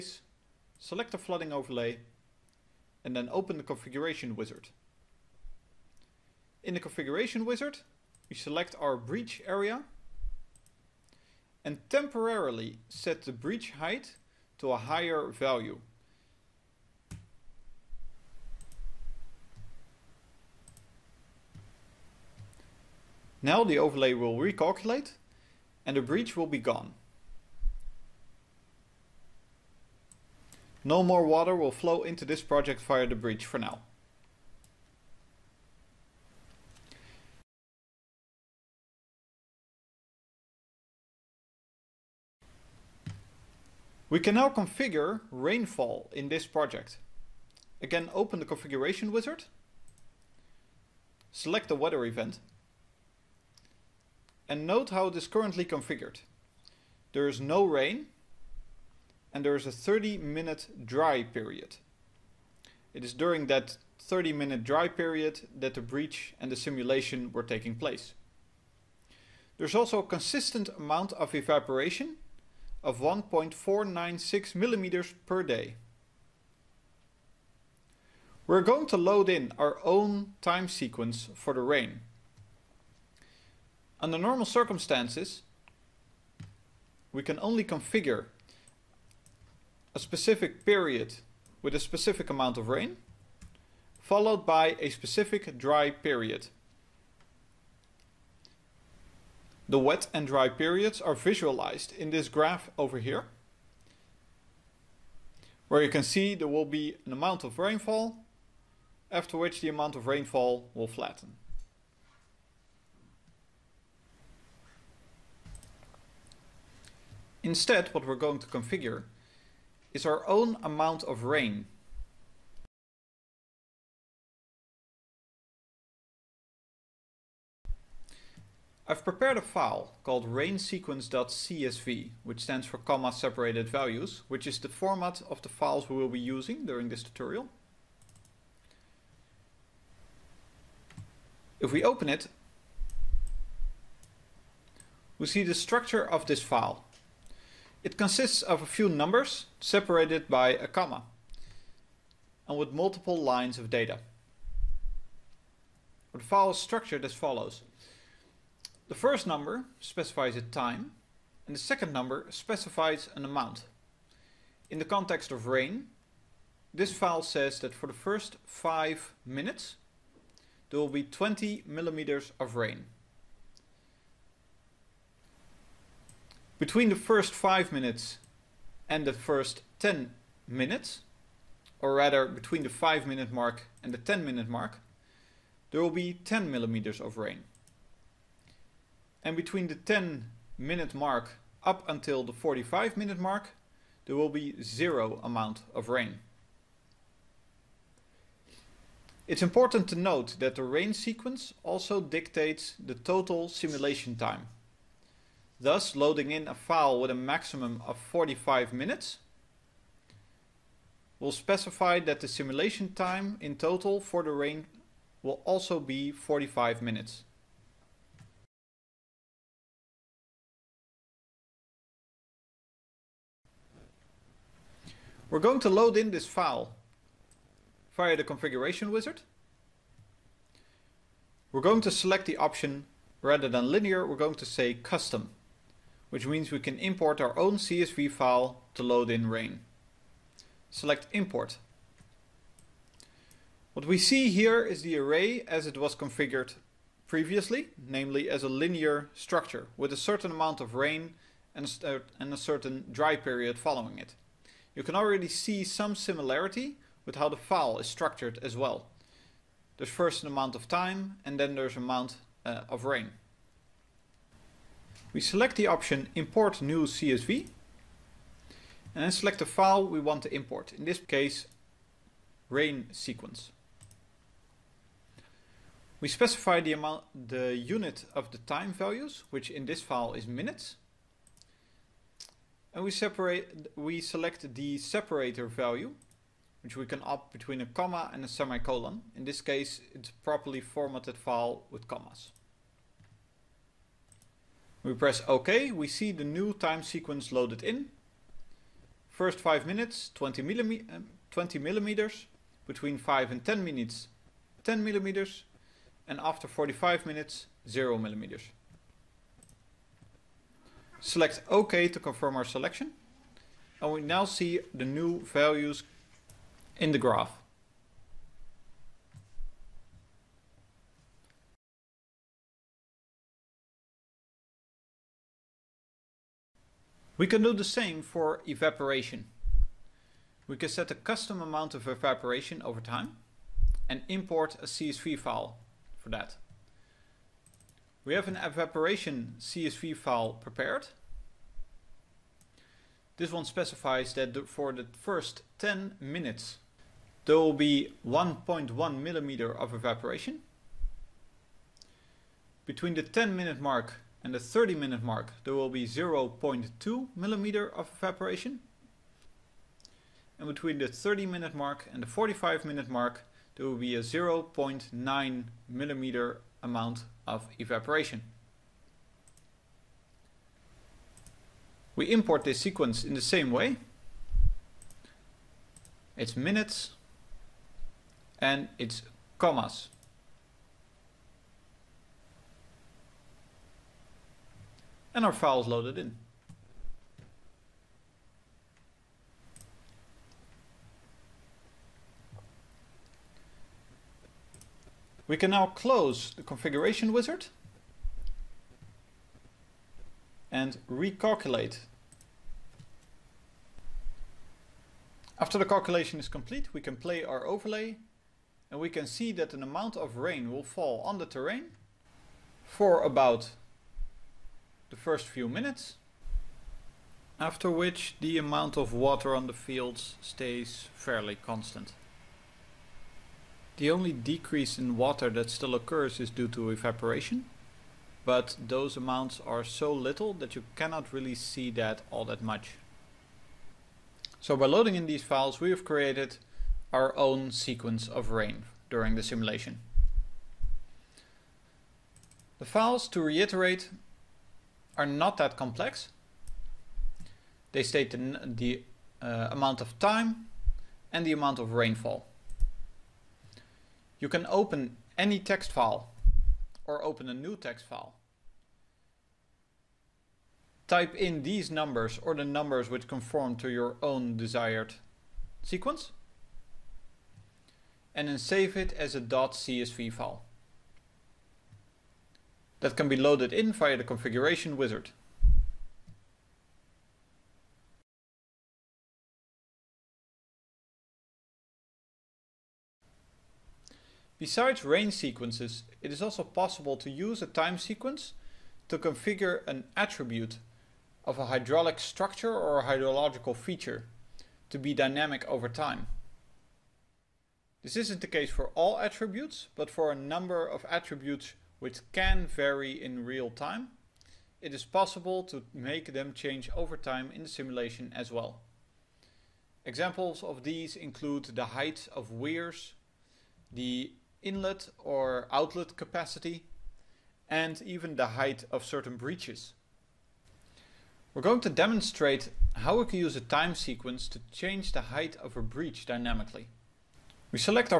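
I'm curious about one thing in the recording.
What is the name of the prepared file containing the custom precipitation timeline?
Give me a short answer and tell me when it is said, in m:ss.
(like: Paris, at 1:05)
rainsequence.csv, at 2:10.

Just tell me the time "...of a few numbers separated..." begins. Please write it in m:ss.
2:28.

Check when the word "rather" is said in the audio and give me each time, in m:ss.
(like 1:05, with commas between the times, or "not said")
3:01, 3:53.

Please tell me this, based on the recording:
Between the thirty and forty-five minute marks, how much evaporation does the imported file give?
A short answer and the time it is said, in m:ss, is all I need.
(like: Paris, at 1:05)
0.9 mm, at 6:04.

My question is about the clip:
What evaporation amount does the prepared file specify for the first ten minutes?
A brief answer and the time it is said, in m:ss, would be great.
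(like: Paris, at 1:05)
1.1 mm, at 5:48.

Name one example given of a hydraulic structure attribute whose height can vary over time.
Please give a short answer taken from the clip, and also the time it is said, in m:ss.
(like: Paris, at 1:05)
height of weirs, at 8:31.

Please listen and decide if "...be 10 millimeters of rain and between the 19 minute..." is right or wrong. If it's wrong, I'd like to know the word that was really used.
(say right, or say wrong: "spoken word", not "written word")
wrong: "10", not "19".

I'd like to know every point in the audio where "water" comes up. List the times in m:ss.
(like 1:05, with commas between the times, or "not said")
0:31, 6:58, 7:04.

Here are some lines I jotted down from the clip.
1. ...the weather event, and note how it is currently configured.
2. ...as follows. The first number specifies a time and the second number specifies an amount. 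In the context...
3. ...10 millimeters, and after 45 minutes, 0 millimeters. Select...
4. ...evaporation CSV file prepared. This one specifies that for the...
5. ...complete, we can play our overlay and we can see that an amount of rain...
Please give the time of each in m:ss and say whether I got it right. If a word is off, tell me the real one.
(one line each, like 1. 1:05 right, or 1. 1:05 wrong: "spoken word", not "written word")
1. 0:51 right
2. 2:37 right
3. 5:04 right
4. 5:38 right
5. 6:46 right.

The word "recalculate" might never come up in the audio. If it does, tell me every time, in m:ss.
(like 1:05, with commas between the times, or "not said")
0:24, 6:40.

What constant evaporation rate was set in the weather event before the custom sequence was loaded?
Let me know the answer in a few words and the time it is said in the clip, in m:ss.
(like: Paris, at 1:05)
1.496 mm per day, at 1:12.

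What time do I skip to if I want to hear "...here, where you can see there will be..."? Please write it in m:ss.
1:42.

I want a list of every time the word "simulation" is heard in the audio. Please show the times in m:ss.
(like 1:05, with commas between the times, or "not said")
1:06, 3:23, 3:32, 7:19, 8:27.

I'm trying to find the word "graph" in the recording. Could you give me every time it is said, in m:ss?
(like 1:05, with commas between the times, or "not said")
1:42, 5:16.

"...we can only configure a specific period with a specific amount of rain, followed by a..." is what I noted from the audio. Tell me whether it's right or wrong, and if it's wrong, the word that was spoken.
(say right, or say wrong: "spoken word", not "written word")
right.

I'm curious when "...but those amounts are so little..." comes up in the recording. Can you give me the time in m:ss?
7:08.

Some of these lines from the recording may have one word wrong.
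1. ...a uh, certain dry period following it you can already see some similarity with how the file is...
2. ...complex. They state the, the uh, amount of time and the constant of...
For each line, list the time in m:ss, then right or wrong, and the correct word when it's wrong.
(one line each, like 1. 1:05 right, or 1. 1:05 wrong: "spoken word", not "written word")
1. 4:11 right
2. 7:25 wrong: "amount", not "constant".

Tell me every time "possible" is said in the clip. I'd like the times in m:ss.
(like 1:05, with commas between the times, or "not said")
8:06, 8:24.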